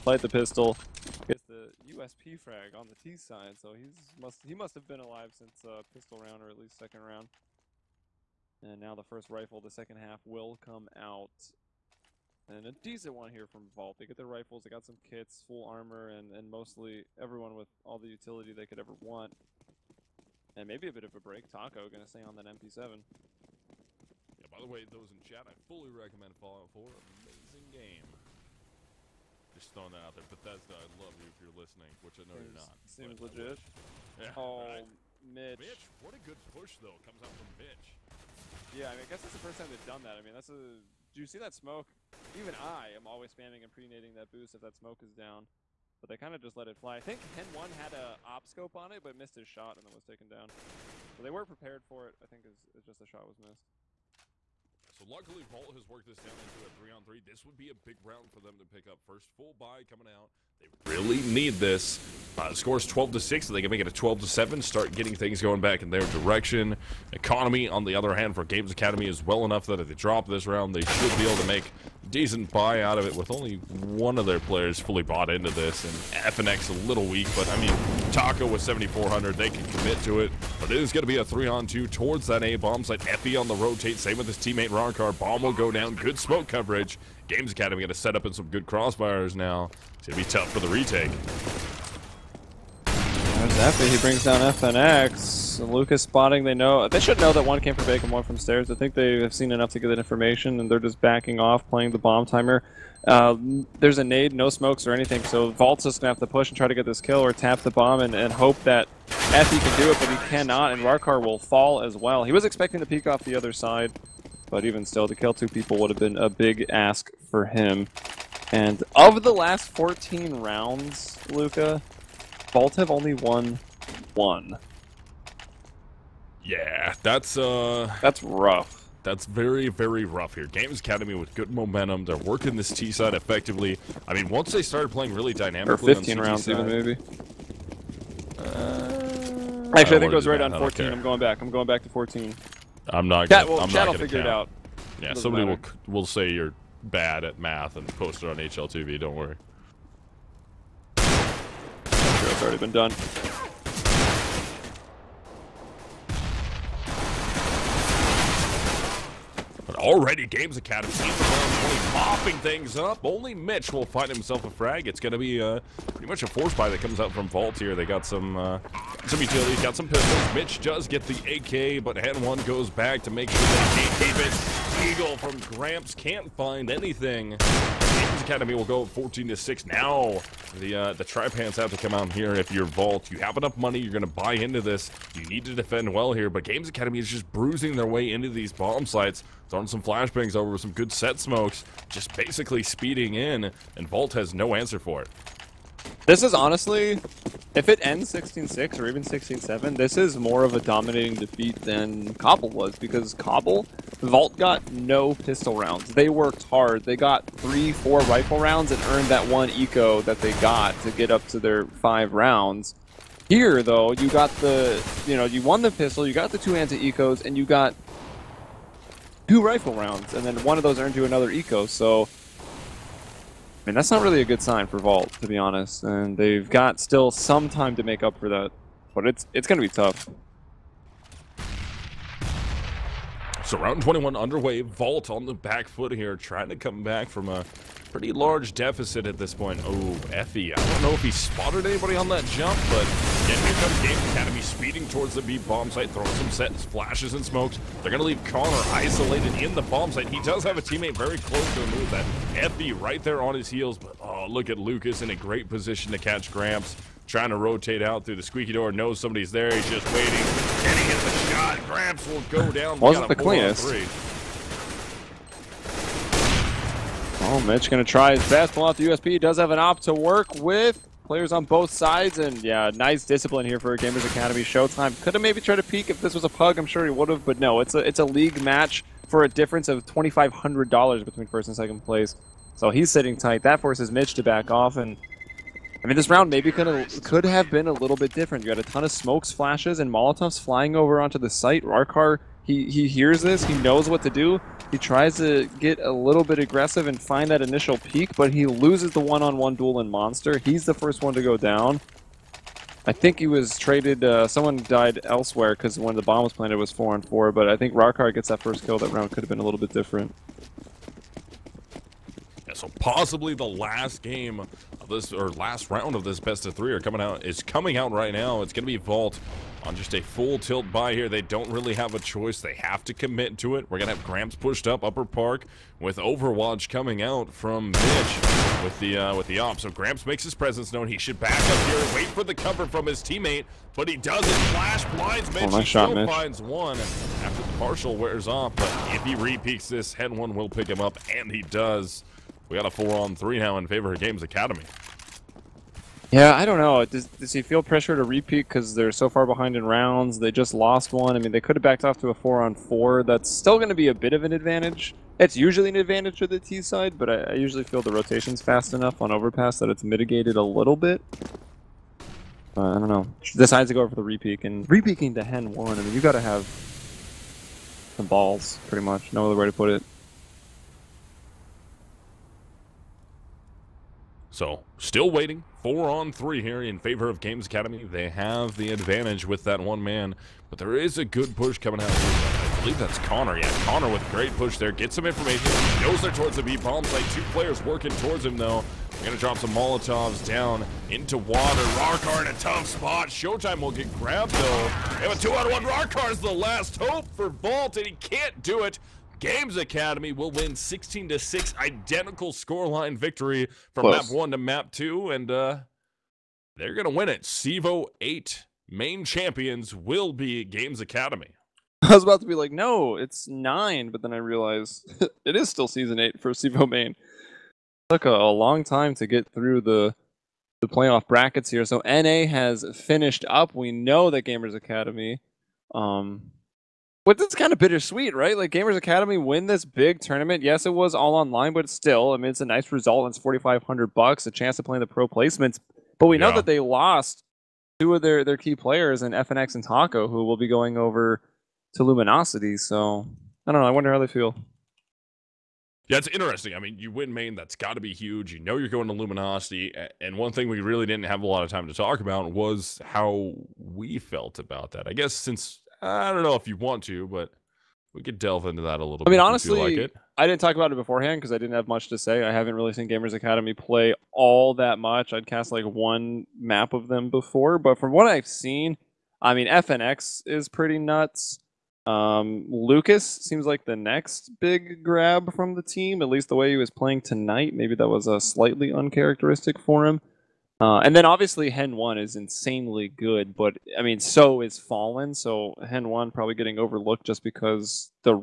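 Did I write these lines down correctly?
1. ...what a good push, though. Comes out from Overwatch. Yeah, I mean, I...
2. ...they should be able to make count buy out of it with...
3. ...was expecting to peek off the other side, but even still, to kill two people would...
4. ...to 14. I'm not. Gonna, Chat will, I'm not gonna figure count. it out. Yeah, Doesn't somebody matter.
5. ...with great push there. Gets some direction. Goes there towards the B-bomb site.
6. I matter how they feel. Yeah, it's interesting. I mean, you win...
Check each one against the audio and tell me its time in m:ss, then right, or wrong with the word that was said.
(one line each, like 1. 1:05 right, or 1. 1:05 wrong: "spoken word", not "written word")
1. 0:36 wrong: "Mitch", not "Overwatch"
2. 1:10 wrong: "decent", not "count"
3. 1:52 right
4. 2:21 right
5. 6:23 wrong: "information", not "direction"
6. 7:23 wrong: "wonder", not "matter".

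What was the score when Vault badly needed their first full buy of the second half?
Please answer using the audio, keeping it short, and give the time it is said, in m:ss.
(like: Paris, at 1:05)
12 to 6, at 1:02.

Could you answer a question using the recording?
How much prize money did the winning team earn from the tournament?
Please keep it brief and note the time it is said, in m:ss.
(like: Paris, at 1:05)
4,500, at 7:13.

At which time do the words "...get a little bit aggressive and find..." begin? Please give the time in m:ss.
4:55.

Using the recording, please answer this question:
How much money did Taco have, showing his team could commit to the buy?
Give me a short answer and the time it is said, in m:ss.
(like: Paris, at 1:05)
7,400, at 1:18.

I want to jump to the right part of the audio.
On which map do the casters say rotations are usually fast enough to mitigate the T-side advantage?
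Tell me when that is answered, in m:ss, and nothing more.
5:59.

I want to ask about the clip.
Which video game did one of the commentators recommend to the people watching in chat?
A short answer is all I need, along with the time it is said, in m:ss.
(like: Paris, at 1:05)
Fallout 4, at 0:26.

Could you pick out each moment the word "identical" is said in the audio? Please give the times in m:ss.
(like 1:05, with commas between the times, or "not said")
6:41.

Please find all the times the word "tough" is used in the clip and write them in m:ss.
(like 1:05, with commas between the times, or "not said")
1:30, 3:49, 6:32.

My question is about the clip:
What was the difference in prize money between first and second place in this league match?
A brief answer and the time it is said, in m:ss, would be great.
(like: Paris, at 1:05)
$2,500, at 4:39.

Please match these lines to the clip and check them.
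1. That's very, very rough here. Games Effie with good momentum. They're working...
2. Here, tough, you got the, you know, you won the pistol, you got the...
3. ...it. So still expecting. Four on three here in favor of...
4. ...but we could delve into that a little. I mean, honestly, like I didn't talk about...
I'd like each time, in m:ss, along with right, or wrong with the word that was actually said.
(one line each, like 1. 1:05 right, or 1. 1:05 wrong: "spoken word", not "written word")
1. 2:09 wrong: "Academy", not "Effie"
2. 3:33 wrong: "though", not "tough"
3. 6:09 wrong: "waiting", not "expecting"
4. 7:37 right.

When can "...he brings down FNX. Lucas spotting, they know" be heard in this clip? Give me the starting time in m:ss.
1:33.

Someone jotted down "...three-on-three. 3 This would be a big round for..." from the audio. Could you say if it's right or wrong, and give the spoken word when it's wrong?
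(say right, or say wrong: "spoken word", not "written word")
right.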